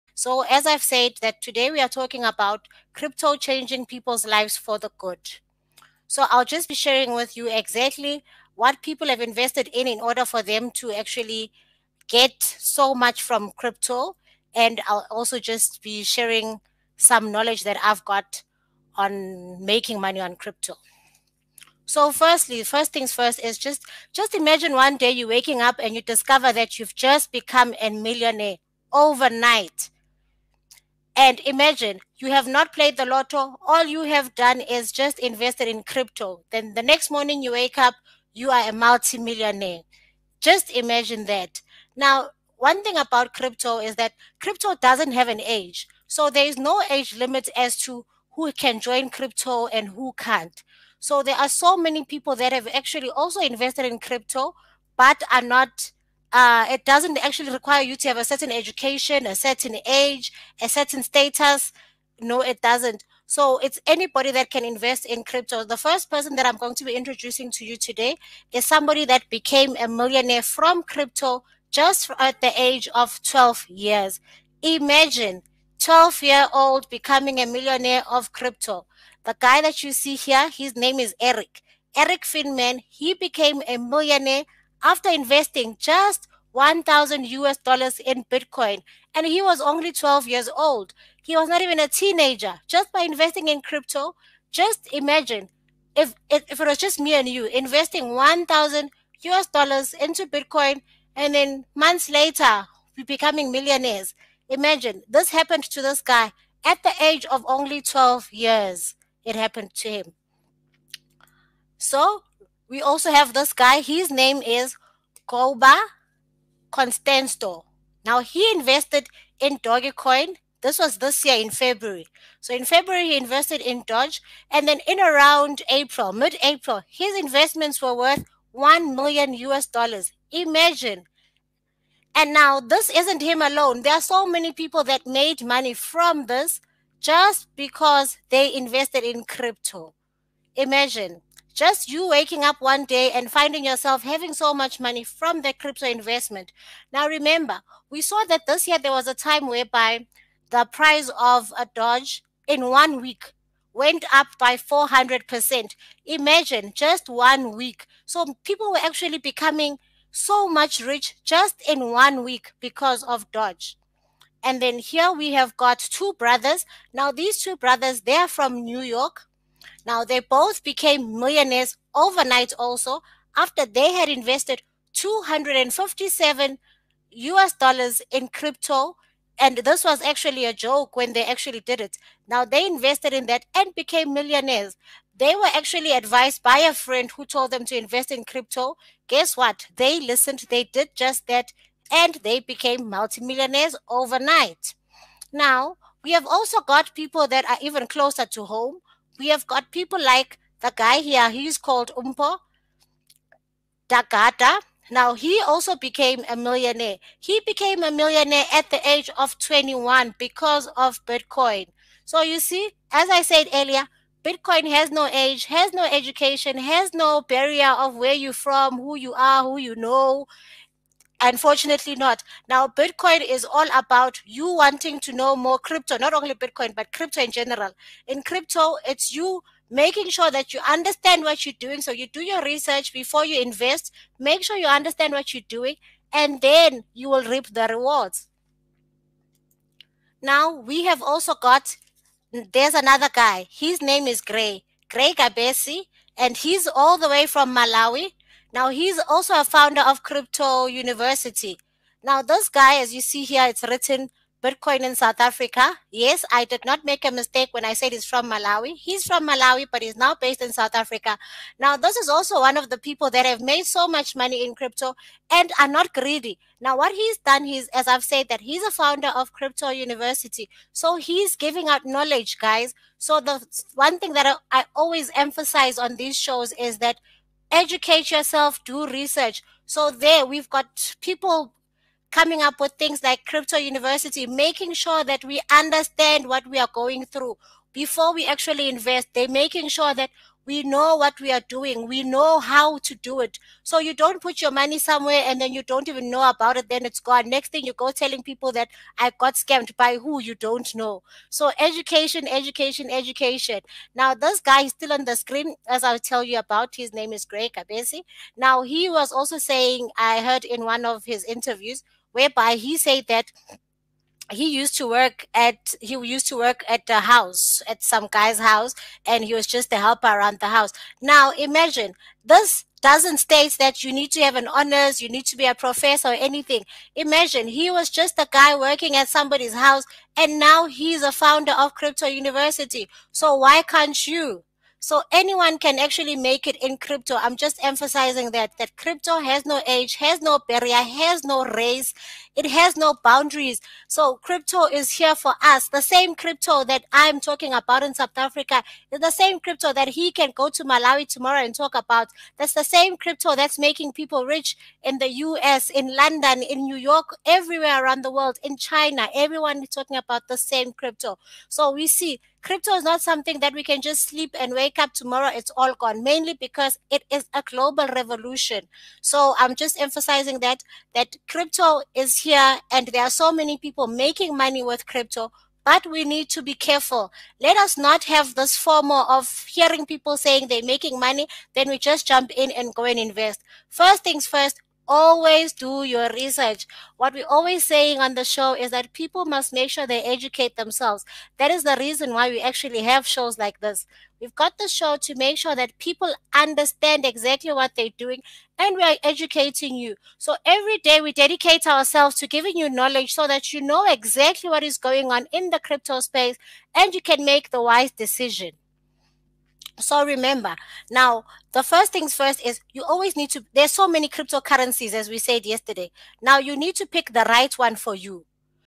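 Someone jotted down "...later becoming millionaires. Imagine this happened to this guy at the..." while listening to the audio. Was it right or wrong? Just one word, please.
right.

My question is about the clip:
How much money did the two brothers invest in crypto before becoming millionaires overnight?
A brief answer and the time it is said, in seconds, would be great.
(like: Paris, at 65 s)
257 US dollars, at 174 s.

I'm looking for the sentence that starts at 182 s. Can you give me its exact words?
Now, they invested in that and became millionaires.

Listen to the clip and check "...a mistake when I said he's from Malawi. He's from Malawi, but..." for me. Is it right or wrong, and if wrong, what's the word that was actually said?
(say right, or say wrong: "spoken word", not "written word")
right.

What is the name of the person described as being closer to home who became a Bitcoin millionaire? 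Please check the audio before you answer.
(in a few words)
Mpho Dagada.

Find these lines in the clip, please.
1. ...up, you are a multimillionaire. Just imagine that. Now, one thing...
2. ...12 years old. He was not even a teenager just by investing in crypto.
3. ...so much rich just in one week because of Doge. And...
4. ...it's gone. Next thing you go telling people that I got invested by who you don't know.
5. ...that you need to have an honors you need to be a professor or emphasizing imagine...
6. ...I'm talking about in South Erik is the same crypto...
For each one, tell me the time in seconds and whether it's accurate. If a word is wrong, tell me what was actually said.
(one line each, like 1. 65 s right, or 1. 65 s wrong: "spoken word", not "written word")
1. 37 s right
2. 89 s right
3. 160 s right
4. 296 s wrong: "scammed", not "invested"
5. 323 s wrong: "anything", not "emphasizing"
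6. 346 s wrong: "Africa", not "Erik".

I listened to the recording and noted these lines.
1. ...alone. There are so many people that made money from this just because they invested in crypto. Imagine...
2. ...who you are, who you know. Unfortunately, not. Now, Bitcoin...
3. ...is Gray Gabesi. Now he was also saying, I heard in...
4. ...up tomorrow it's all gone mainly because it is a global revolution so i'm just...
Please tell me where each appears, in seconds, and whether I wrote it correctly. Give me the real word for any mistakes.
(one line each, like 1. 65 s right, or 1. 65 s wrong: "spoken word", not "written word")
1. 133 s right
2. 218 s right
3. 307 s right
4. 364 s right.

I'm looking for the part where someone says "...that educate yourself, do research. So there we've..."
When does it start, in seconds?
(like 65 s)
276 s.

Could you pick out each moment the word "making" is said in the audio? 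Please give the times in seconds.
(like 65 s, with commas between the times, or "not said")
19 s, 229 s, 284 s, 289 s, 353 s, 373 s, 380 s.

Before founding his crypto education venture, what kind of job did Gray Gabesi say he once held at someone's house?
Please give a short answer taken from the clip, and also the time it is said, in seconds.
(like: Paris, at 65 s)
helper, at 319 s.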